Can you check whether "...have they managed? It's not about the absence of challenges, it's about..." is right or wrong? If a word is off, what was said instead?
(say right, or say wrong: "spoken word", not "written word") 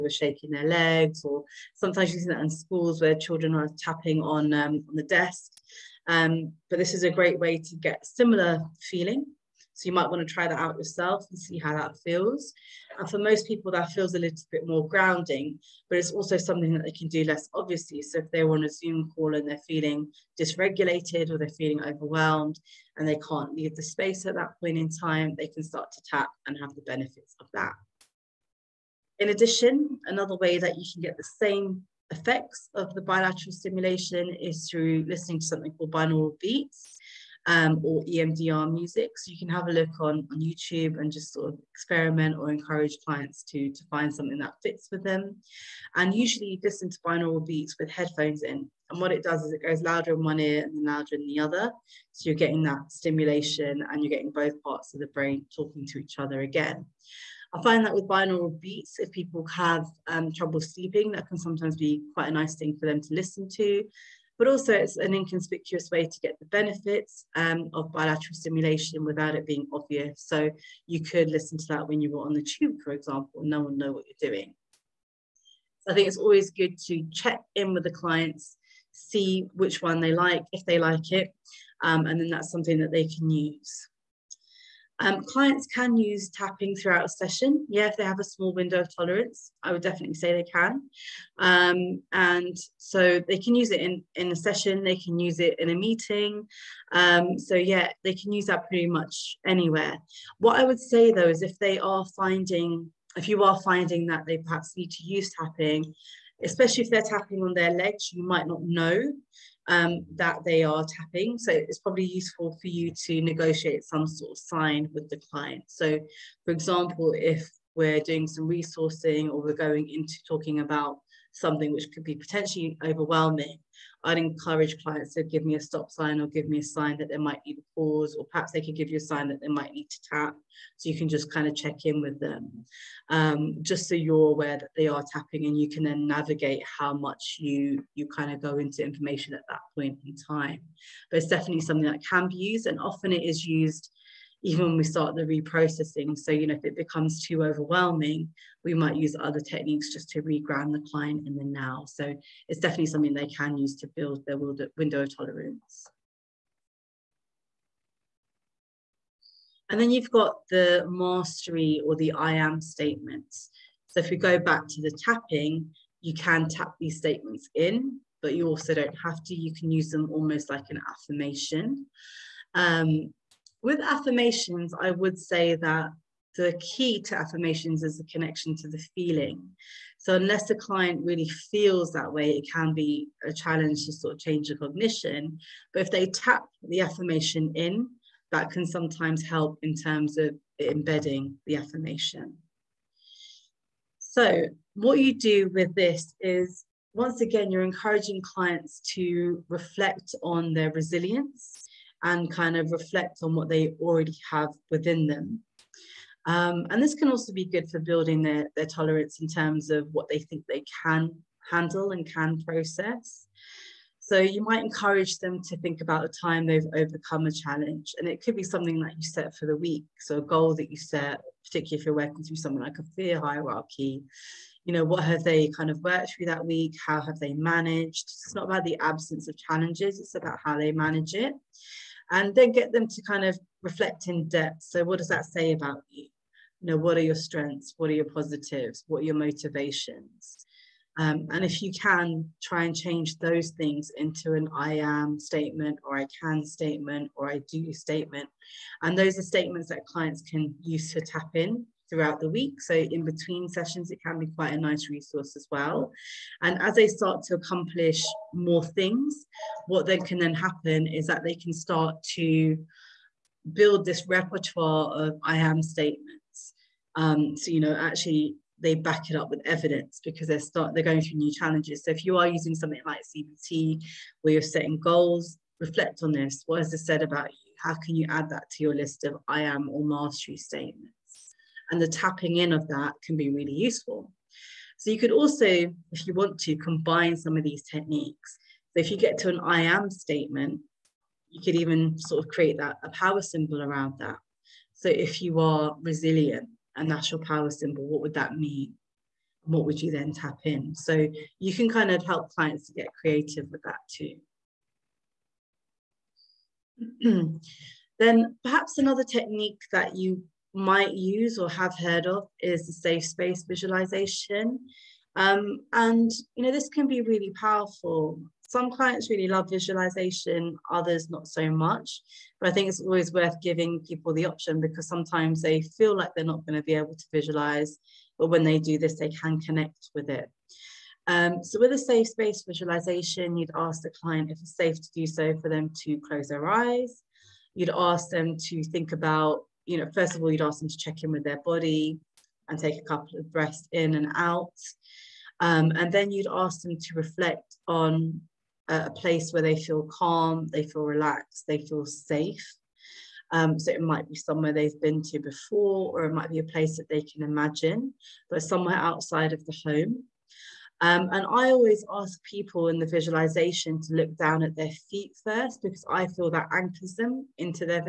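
right.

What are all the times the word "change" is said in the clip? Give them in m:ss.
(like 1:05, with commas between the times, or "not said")
3:04, 4:02.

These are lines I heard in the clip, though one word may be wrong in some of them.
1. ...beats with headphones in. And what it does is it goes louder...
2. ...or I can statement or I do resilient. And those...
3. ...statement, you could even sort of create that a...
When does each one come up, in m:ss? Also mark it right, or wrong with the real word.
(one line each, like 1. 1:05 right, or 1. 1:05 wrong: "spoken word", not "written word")
1. 0:47 right
2. 4:05 wrong: "statement", not "resilient"
3. 4:49 right.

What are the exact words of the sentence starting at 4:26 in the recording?
Um, so, you know, actually they back it up with evidence because they're start they're going through new challenges.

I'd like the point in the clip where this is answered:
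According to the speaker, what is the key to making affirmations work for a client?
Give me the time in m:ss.
2:58.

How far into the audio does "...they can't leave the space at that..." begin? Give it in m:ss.
0:23.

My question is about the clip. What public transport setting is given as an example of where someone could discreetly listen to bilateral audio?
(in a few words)
The tube.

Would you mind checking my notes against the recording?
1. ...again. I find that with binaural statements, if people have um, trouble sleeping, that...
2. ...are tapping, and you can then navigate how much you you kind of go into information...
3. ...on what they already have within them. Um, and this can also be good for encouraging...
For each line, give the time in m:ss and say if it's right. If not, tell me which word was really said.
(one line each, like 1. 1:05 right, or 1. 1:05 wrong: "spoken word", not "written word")
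1. 0:56 wrong: "beats", not "statements"
2. 2:14 right
3. 3:23 wrong: "building", not "encouraging".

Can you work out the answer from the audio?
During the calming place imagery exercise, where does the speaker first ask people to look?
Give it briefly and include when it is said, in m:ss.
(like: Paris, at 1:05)
Down at their feet, at 6:04.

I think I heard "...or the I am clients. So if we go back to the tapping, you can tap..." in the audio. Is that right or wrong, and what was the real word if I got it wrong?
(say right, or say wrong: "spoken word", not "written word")
wrong: "statements", not "clients".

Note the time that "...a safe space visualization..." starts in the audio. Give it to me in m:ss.
5:31.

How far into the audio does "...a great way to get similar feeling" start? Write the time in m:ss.
0:07.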